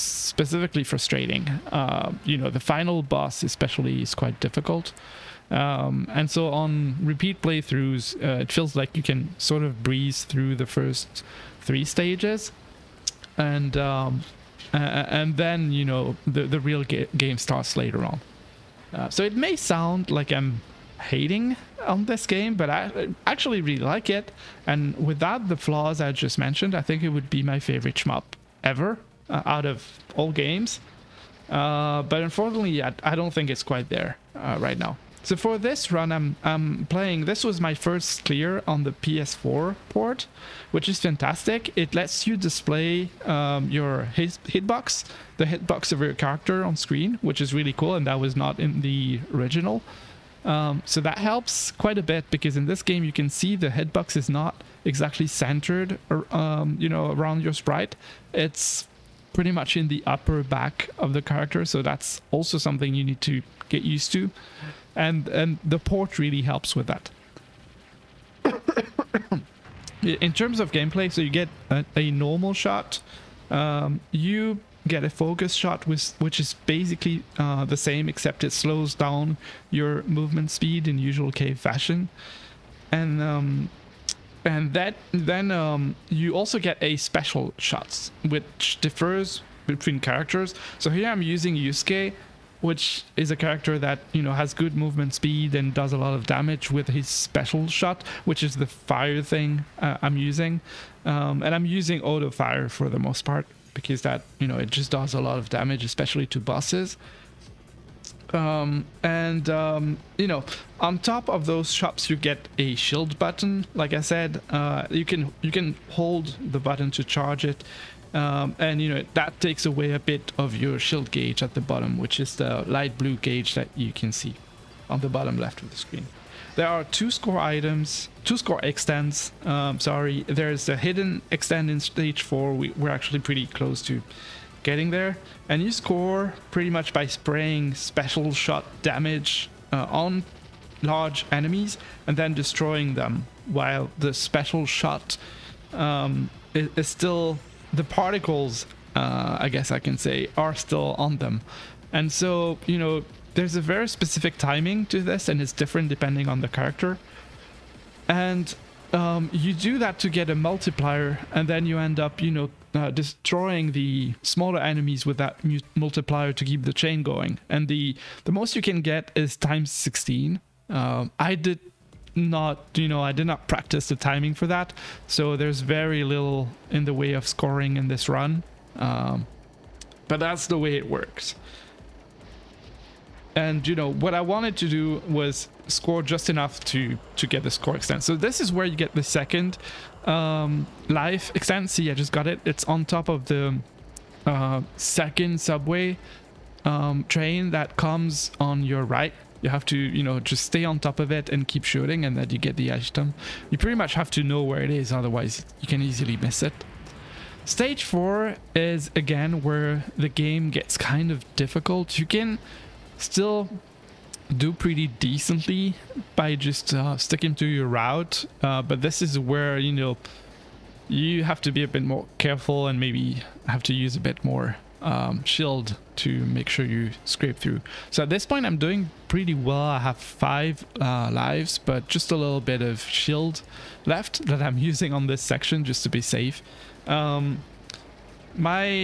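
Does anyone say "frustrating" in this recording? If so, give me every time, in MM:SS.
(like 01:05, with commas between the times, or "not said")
00:00.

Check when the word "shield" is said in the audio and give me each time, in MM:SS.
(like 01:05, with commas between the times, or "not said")
01:52, 02:00, 03:45, 03:52.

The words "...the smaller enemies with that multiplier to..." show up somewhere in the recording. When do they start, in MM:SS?
02:43.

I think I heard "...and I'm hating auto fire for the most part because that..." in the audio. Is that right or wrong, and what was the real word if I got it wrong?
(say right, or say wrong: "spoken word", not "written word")
wrong: "using", not "hating".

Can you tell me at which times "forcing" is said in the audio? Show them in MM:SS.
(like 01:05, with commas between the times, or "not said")
not said.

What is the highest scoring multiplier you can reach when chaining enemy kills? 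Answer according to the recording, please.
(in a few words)
x16.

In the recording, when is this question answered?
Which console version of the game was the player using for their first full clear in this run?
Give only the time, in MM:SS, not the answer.
00:38.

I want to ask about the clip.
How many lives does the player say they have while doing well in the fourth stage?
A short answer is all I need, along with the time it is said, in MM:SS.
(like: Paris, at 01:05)
5, at 03:49.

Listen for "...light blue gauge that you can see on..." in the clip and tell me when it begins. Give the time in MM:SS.
02:02.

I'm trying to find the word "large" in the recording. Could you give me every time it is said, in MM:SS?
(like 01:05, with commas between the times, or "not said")
02:20.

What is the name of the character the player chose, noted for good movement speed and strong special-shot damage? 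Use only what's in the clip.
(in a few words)
Yusuke.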